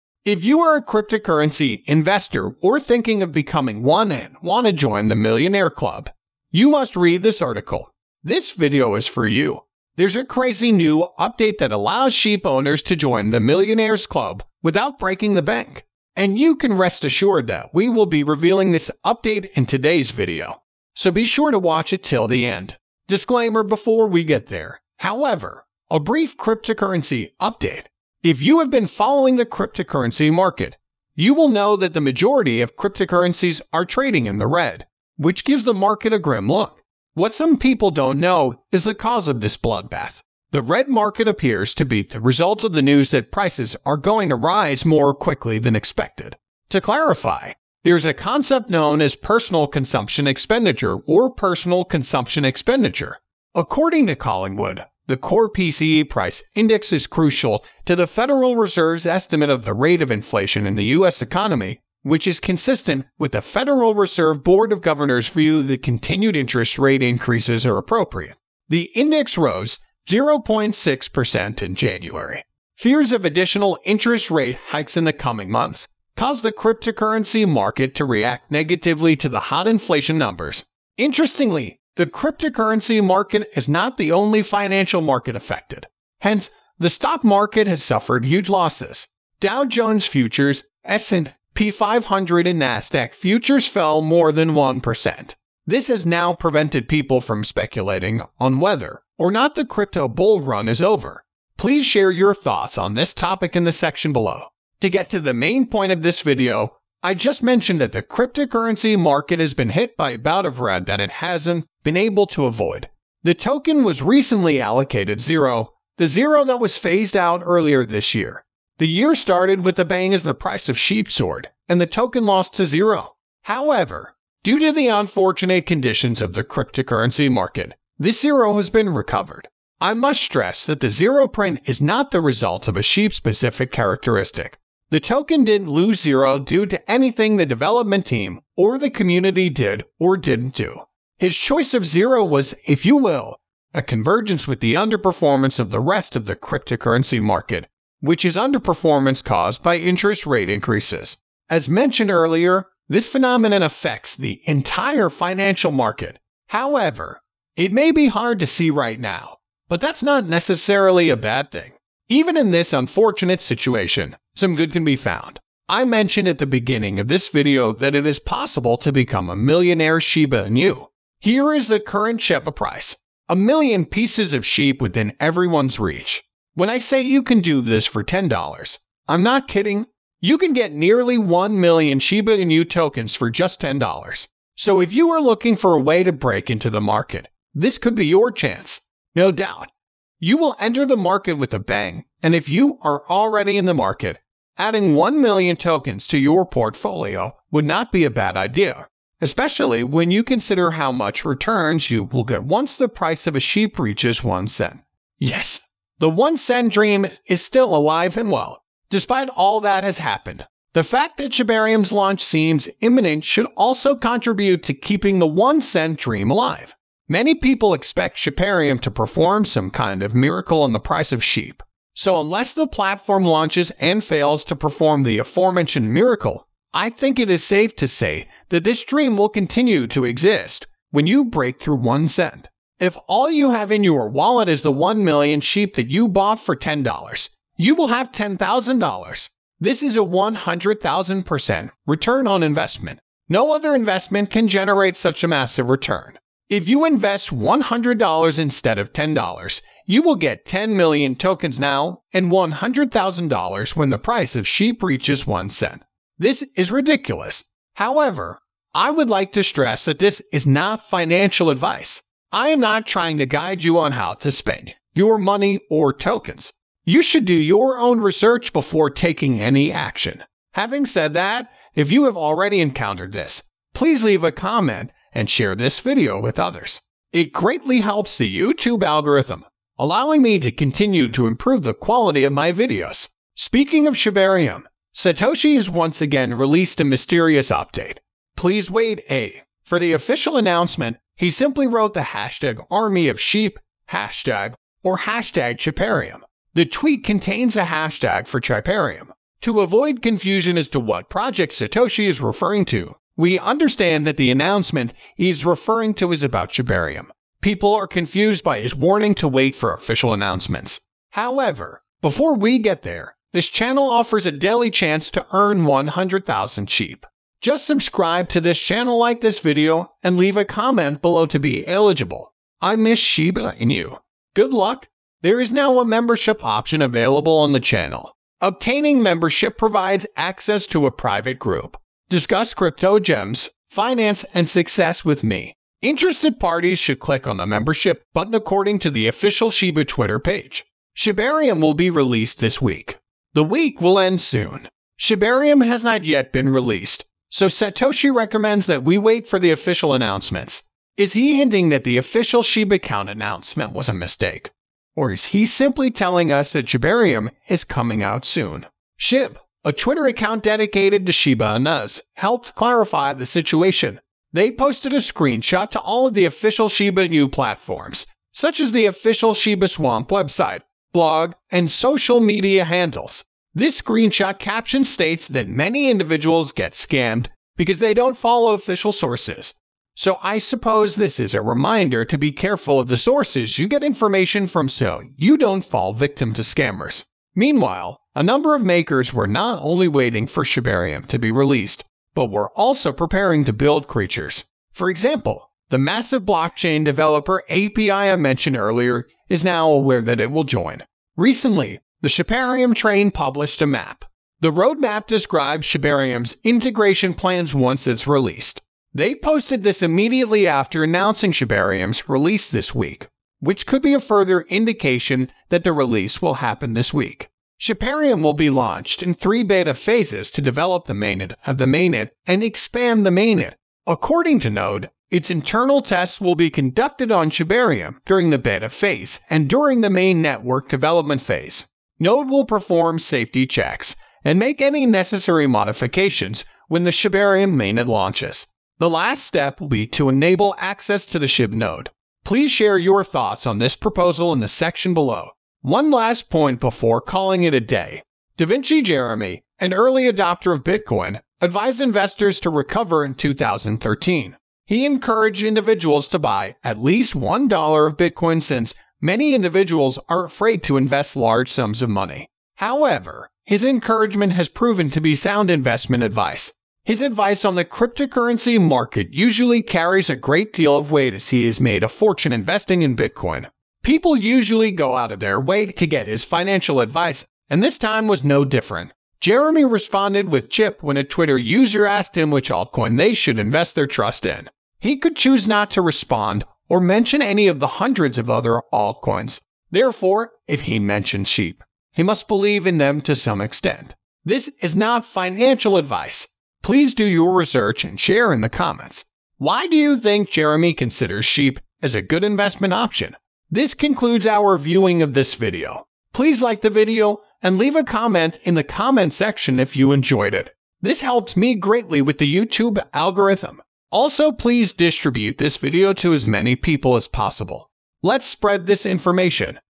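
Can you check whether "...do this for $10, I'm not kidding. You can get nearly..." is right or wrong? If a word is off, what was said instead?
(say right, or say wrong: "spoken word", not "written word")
right.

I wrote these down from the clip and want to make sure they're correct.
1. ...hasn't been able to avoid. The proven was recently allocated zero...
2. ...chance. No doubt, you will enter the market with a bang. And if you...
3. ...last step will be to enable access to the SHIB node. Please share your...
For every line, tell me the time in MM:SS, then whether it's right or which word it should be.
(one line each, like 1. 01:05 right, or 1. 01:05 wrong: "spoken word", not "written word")
1. 01:51 wrong: "token", not "proven"
2. 03:08 right
3. 07:18 right.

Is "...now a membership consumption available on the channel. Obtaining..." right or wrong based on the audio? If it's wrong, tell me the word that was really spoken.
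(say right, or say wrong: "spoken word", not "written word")
wrong: "option", not "consumption".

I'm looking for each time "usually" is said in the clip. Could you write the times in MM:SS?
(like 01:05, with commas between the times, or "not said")
07:49, 07:54.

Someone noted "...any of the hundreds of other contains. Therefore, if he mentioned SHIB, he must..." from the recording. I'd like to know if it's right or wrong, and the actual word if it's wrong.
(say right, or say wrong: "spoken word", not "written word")
wrong: "altcoins", not "contains".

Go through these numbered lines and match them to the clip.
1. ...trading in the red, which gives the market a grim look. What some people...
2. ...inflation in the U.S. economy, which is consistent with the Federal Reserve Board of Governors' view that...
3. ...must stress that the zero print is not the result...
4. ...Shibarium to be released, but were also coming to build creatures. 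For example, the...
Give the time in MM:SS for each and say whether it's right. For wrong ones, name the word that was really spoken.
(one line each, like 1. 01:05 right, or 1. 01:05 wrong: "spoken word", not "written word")
1. 00:33 right
2. 01:00 right
3. 02:09 right
4. 06:30 wrong: "preparing", not "coming".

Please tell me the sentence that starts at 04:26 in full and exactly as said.
You should do your own research before taking any action.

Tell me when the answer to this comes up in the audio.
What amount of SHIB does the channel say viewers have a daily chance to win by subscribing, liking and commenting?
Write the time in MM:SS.
05:15.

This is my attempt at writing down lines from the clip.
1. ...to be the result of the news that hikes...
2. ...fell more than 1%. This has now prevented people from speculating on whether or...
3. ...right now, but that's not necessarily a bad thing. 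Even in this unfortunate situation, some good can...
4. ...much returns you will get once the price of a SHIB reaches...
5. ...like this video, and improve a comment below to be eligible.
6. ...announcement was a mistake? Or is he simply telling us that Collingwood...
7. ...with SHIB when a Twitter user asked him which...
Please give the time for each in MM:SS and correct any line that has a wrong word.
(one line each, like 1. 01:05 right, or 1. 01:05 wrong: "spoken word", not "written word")
1. 00:41 wrong: "prices", not "hikes"
2. 01:33 right
3. 02:38 right
4. 03:20 right
5. 05:18 wrong: "leave", not "improve"
6. 05:53 wrong: "Shibarium", not "Collingwood"
7. 08:00 right.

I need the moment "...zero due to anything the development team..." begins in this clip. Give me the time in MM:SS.
02:16.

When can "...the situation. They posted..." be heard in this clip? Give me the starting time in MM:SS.
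06:03.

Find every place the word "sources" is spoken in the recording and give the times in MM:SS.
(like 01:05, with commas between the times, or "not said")
06:18, 06:22.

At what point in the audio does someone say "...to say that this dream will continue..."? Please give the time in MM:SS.
03:47.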